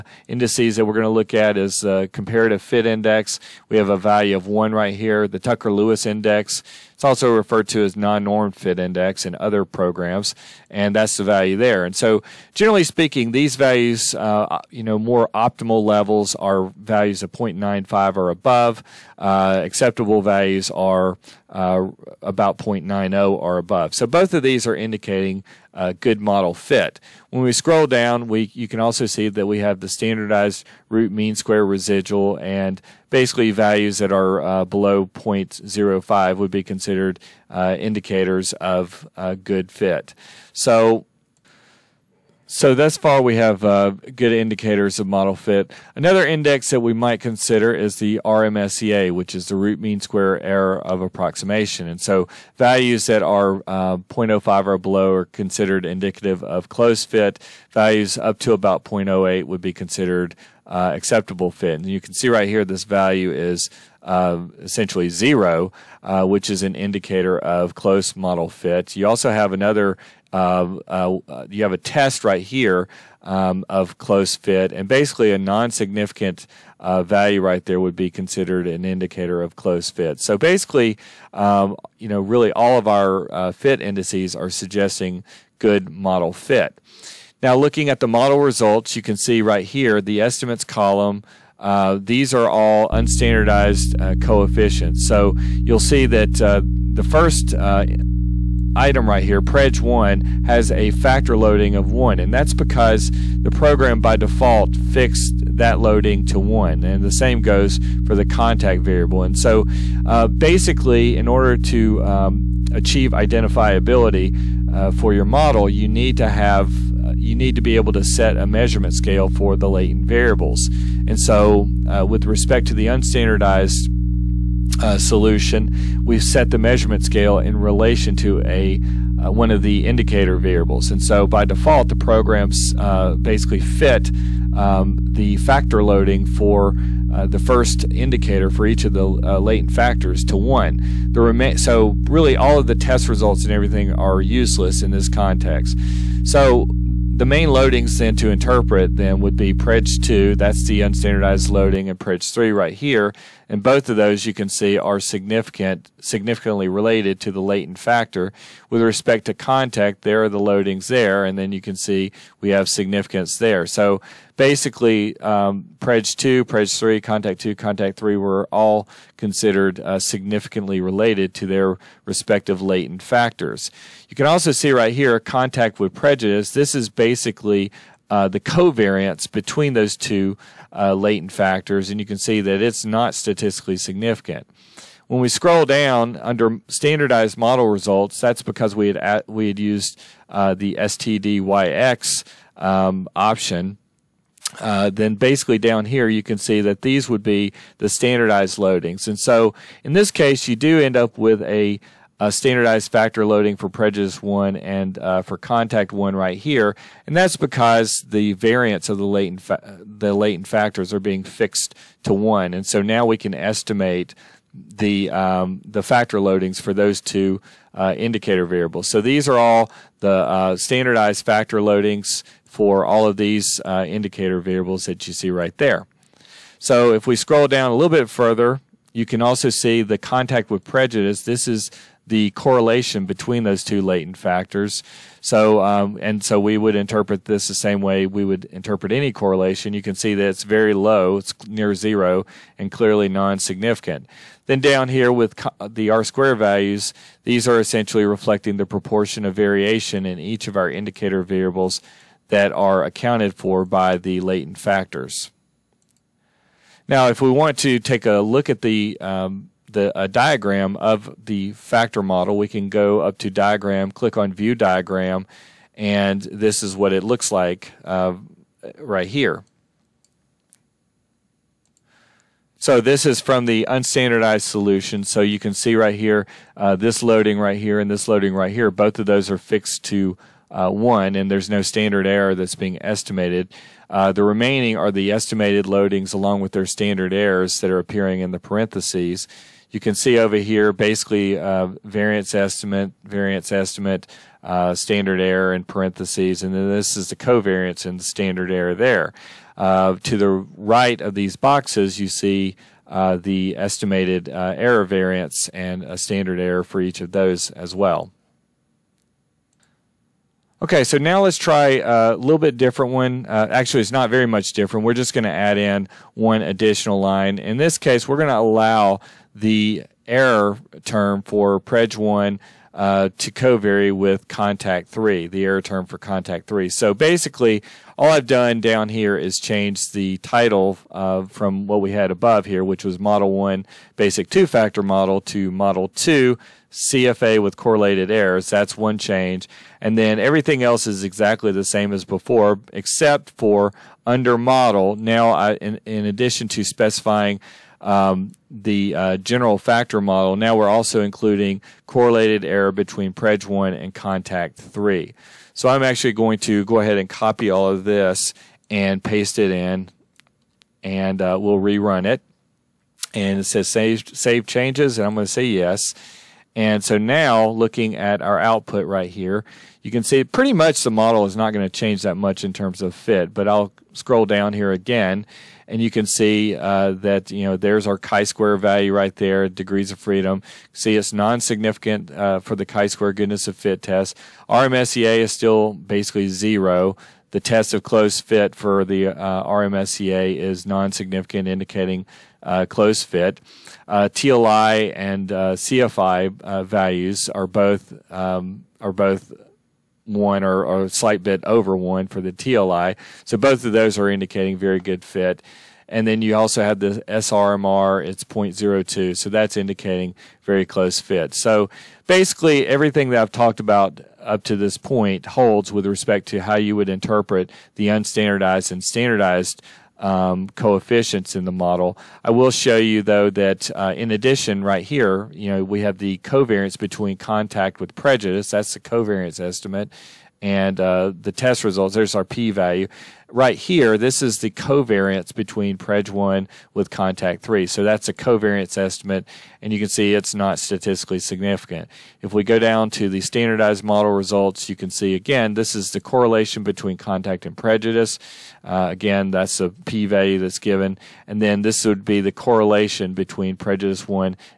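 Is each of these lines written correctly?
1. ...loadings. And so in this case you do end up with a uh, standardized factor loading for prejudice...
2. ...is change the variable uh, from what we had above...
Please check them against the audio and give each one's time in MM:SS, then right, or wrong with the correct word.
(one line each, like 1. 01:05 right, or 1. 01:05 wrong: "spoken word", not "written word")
1. 03:18 right
2. 05:29 wrong: "title", not "variable".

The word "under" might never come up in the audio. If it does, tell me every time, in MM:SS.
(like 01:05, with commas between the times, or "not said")
03:06, 05:44.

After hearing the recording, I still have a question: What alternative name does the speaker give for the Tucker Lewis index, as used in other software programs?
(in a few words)
non-norm fit index.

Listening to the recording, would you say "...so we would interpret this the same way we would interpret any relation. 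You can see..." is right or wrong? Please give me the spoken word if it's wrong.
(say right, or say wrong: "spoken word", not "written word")
wrong: "correlation", not "relation".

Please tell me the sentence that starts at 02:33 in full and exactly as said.
And both of those you can see are significant, significantly related to the latent factor.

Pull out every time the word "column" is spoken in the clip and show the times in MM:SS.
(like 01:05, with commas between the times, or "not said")
01:30.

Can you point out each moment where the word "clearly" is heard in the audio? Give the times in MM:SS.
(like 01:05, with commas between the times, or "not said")
04:02.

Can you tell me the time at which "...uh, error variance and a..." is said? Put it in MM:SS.
05:04.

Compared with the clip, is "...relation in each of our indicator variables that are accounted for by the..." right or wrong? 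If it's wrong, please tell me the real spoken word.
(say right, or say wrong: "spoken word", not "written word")
wrong: "variation", not "relation".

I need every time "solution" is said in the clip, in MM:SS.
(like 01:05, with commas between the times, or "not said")
02:04, 04:34.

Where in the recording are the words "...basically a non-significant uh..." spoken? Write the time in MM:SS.
01:14.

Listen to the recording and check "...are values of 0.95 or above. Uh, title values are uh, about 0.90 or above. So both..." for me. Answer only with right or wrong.
wrong.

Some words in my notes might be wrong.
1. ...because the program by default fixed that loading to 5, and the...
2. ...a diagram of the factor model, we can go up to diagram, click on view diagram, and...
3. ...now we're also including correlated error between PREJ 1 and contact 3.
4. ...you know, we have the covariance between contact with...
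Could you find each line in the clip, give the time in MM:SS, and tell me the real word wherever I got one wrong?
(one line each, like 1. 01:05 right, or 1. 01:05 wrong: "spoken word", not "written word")
1. 01:42 wrong: "1", not "5"
2. 04:19 right
3. 05:50 right
4. 07:05 right.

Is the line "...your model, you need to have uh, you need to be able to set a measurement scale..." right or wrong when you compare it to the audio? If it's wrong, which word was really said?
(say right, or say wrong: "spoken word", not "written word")
right.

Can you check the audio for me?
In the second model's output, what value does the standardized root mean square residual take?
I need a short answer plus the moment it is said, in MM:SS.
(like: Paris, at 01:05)
0.02, at 06:48.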